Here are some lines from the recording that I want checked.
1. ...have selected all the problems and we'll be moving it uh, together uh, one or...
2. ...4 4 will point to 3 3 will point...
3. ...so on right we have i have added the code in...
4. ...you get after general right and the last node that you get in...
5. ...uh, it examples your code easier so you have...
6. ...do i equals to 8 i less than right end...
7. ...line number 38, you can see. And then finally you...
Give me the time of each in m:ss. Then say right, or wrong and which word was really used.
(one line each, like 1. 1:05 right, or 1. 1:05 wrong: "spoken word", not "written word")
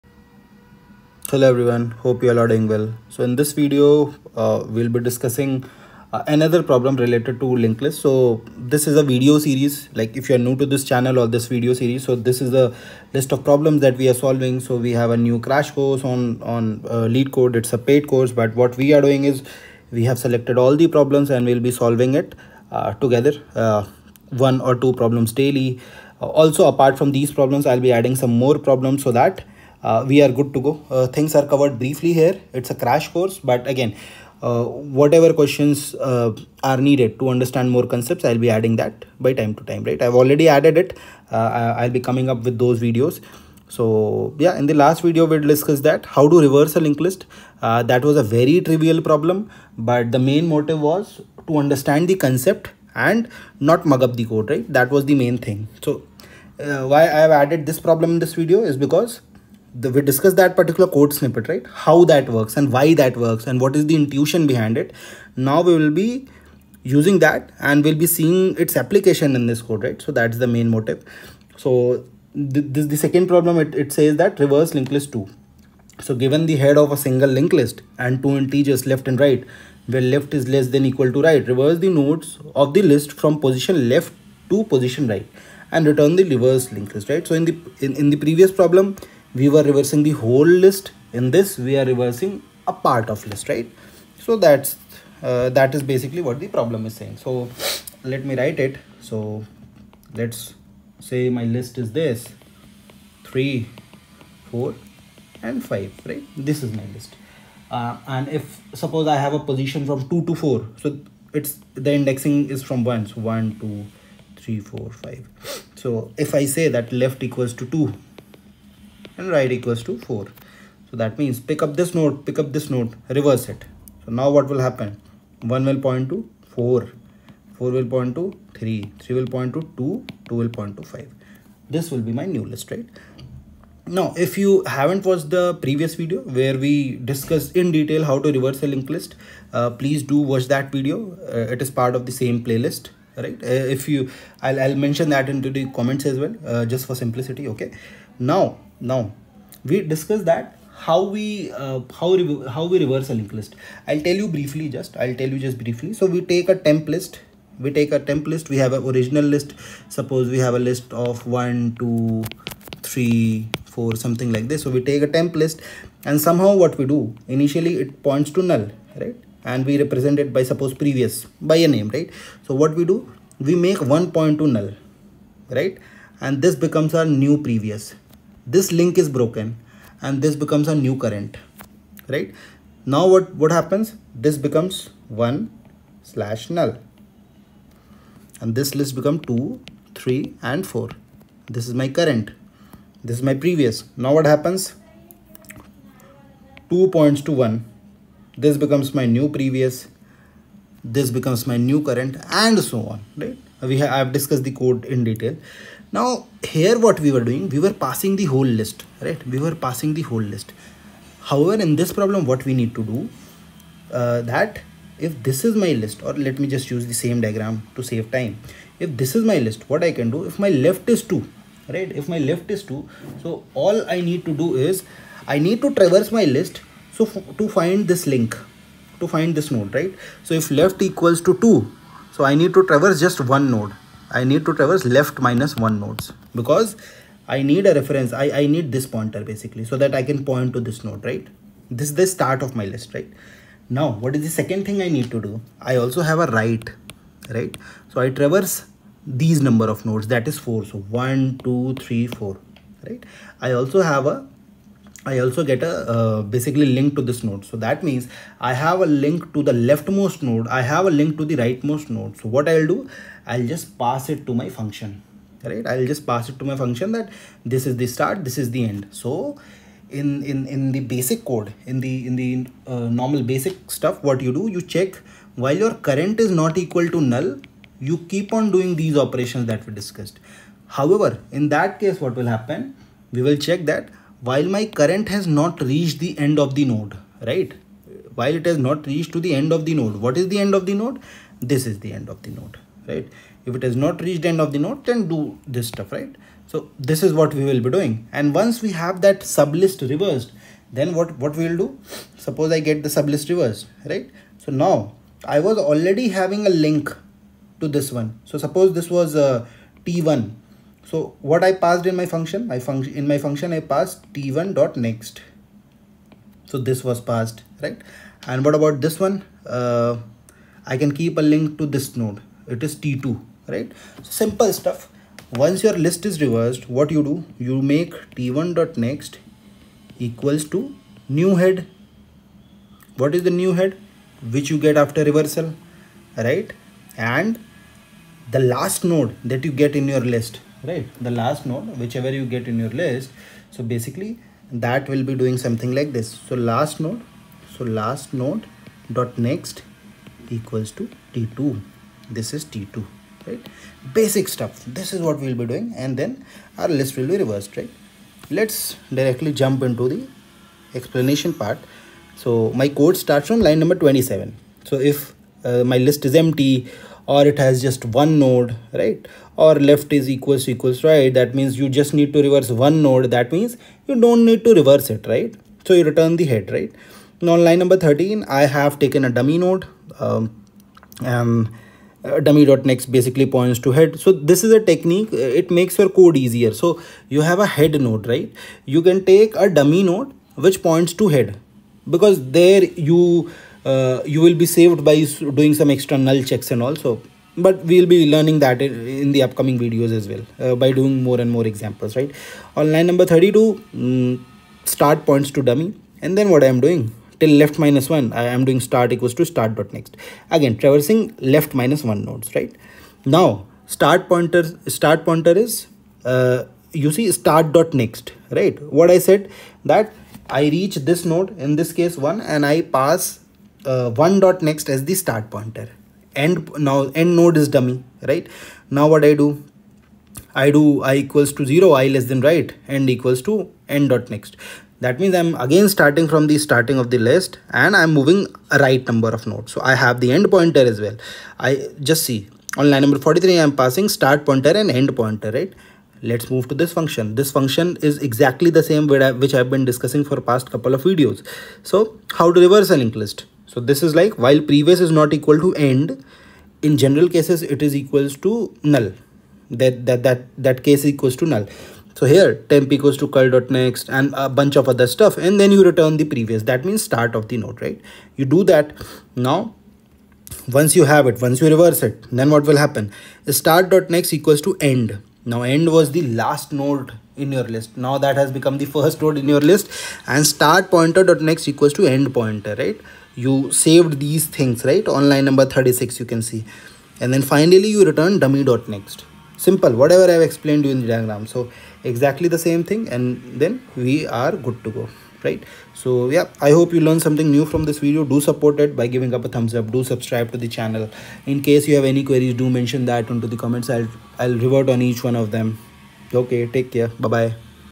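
1. 0:20 wrong: "solving", not "moving"
2. 2:06 right
3. 3:22 wrong: "discussed", not "added"
4. 5:34 wrong: "reversal", not "general"
5. 6:25 wrong: "makes", not "examples"
6. 7:10 wrong: "0", not "8"
7. 8:05 wrong: "36", not "38".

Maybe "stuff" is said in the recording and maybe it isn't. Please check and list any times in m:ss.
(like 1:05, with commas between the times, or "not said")
4:33, 4:55, 5:24, 5:54, 7:44.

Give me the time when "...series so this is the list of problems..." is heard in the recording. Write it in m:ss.
0:11.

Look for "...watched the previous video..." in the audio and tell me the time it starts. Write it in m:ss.
2:15.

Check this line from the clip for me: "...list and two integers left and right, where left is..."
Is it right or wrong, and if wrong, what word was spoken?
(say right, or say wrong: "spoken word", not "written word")
right.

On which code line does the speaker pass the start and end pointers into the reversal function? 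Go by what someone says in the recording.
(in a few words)
43.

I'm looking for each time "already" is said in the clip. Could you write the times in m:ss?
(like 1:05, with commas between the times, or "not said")
0:40, 5:05.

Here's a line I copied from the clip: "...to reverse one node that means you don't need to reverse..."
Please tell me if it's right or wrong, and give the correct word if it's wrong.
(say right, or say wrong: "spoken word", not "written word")
right.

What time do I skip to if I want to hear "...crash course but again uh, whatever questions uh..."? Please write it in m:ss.
0:32.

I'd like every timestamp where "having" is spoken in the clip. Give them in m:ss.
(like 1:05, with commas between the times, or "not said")
5:06.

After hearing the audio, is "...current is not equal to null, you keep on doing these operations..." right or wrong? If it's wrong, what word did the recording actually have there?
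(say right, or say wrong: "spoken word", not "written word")
right.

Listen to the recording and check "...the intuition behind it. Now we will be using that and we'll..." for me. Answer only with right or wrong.
right.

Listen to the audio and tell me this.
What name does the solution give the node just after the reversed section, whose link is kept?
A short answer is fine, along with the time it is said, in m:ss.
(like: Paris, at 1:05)
t2, at 5:22.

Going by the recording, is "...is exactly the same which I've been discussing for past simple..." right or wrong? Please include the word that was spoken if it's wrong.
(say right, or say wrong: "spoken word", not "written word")
wrong: "couple", not "simple".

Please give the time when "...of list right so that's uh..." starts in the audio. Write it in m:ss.
1:33.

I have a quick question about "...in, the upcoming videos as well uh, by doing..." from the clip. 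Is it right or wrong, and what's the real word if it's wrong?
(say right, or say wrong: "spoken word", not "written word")
right.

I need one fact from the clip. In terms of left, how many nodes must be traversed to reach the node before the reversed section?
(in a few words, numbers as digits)
left minus 1.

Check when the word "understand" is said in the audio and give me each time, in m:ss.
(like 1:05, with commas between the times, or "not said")
0:37, 0:51.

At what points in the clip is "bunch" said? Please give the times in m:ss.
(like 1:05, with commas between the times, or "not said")
7:44.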